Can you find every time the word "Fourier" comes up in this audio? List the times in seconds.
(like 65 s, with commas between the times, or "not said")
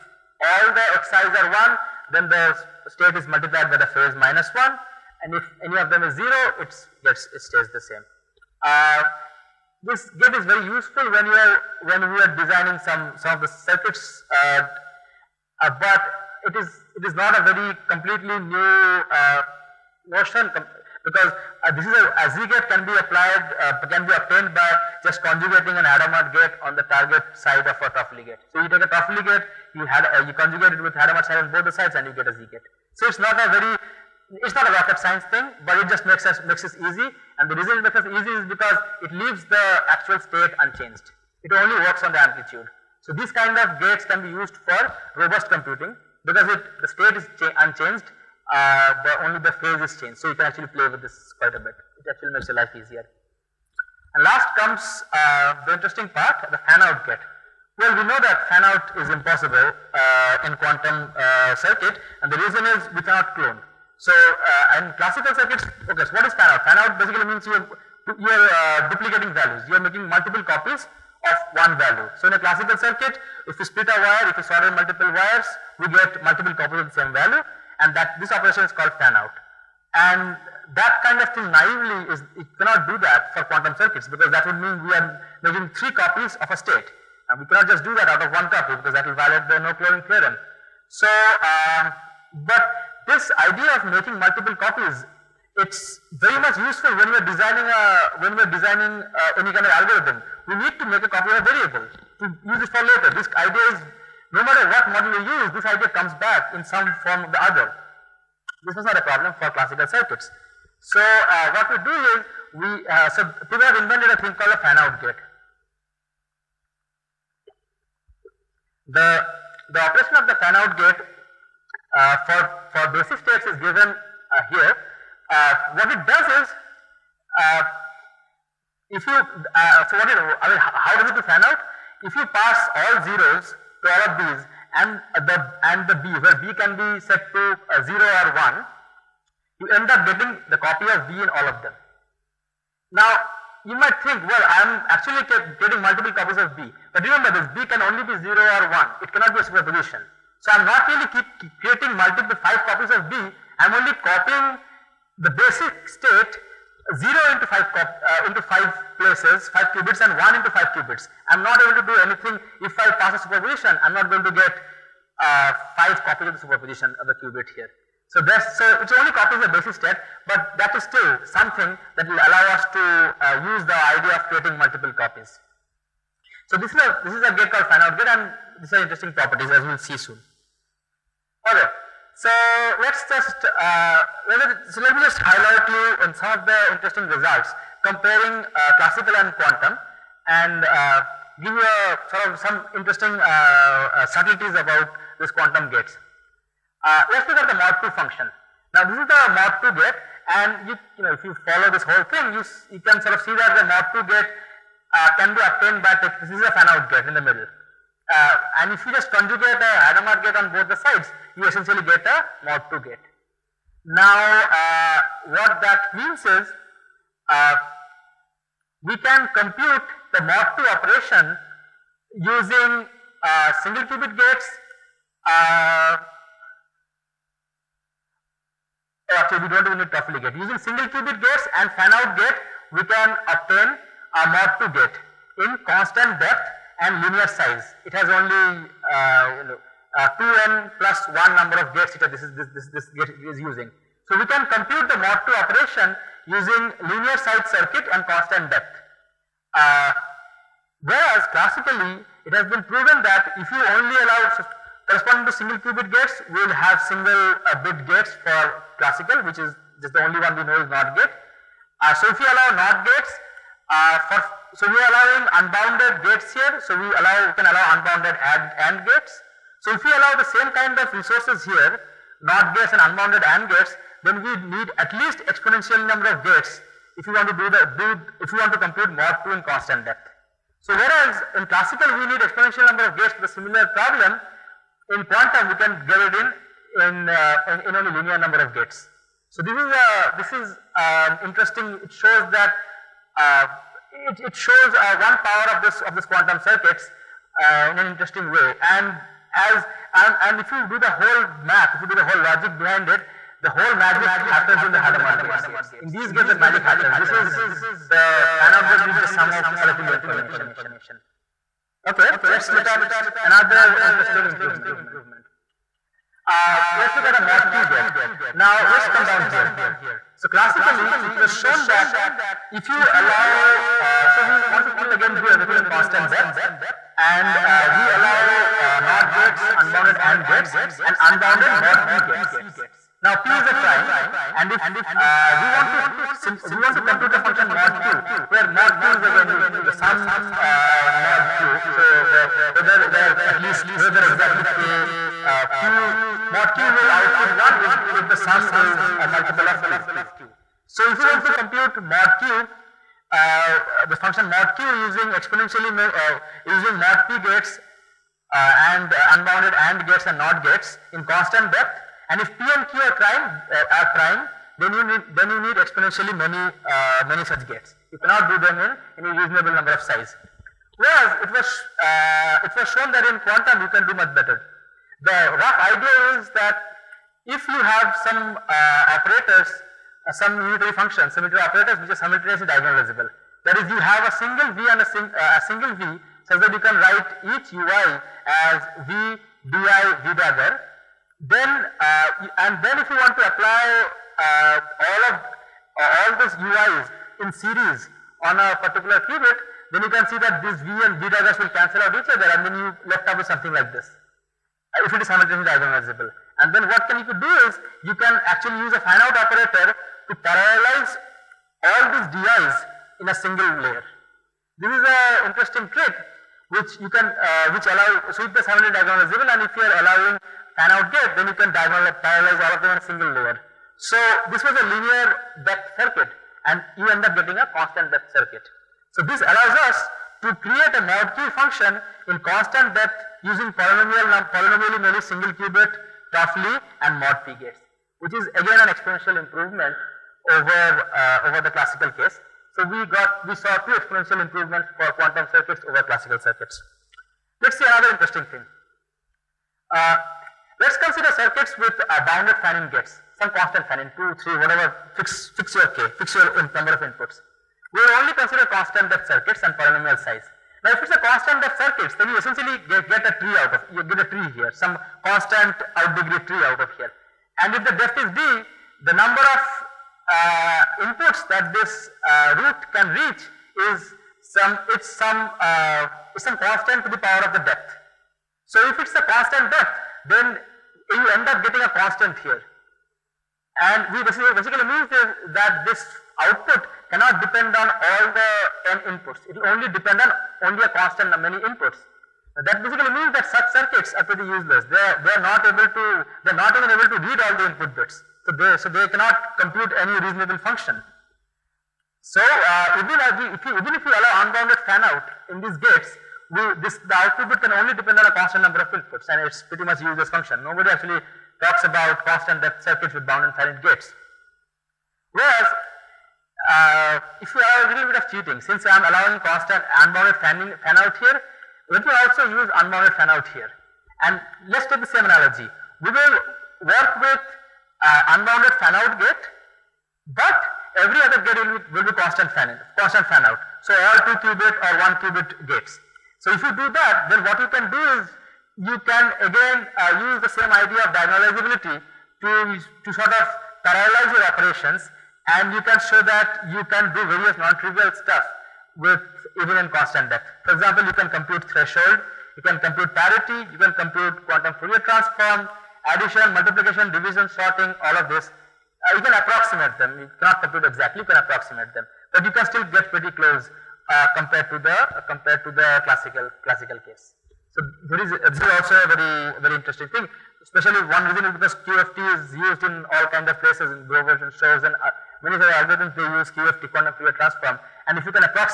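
554 s, 577 s.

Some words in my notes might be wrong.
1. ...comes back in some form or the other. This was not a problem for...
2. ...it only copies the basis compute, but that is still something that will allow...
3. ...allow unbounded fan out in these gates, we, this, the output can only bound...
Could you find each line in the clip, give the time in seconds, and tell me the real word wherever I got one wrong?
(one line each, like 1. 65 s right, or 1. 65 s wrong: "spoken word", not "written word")
1. 105 s right
2. 168 s wrong: "state", not "compute"
3. 503 s wrong: "depend", not "bound".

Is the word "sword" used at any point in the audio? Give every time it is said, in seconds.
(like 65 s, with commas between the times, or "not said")
not said.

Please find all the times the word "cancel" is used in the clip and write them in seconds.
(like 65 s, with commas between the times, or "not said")
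401 s.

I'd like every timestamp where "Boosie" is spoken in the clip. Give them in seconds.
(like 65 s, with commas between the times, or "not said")
not said.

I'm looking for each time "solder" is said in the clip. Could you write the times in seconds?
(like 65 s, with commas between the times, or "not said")
74 s.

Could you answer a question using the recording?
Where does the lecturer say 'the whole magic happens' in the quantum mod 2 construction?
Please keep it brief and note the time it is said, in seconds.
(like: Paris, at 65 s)
Hadamard gates, at 304 s.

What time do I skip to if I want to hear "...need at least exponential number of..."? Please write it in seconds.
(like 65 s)
274 s.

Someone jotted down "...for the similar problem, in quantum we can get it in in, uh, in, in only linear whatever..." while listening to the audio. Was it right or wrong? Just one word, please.
wrong.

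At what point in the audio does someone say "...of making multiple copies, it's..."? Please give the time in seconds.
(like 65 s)
93 s.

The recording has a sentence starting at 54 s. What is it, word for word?
And last comes uh, the interesting part, the fan-out get.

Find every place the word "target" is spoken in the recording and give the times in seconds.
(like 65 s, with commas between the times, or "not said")
26 s.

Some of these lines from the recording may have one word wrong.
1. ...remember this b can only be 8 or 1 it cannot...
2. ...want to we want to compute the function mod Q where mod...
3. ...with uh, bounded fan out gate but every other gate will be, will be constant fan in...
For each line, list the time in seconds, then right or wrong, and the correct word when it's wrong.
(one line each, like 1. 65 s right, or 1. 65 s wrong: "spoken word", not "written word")
1. 147 s wrong: "0", not "8"
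2. 335 s right
3. 527 s wrong: "unbounded", not "bounded".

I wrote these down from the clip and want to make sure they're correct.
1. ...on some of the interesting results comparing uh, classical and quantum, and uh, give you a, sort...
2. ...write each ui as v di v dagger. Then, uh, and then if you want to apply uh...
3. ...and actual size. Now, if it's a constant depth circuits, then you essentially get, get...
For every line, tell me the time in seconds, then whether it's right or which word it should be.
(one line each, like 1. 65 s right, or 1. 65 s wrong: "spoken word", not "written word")
1. 186 s right
2. 386 s right
3. 459 s wrong: "polynomial", not "actual".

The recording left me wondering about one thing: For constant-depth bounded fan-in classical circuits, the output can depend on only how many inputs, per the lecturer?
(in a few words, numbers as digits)
a constant many.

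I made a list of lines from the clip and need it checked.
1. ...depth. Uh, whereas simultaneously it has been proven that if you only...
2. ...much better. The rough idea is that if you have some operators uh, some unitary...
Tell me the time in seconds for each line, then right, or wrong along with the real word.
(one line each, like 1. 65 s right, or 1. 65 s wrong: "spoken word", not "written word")
1. 248 s wrong: "classically", not "simultaneously"
2. 373 s right.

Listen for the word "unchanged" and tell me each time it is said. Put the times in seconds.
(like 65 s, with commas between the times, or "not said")
40 s, 47 s.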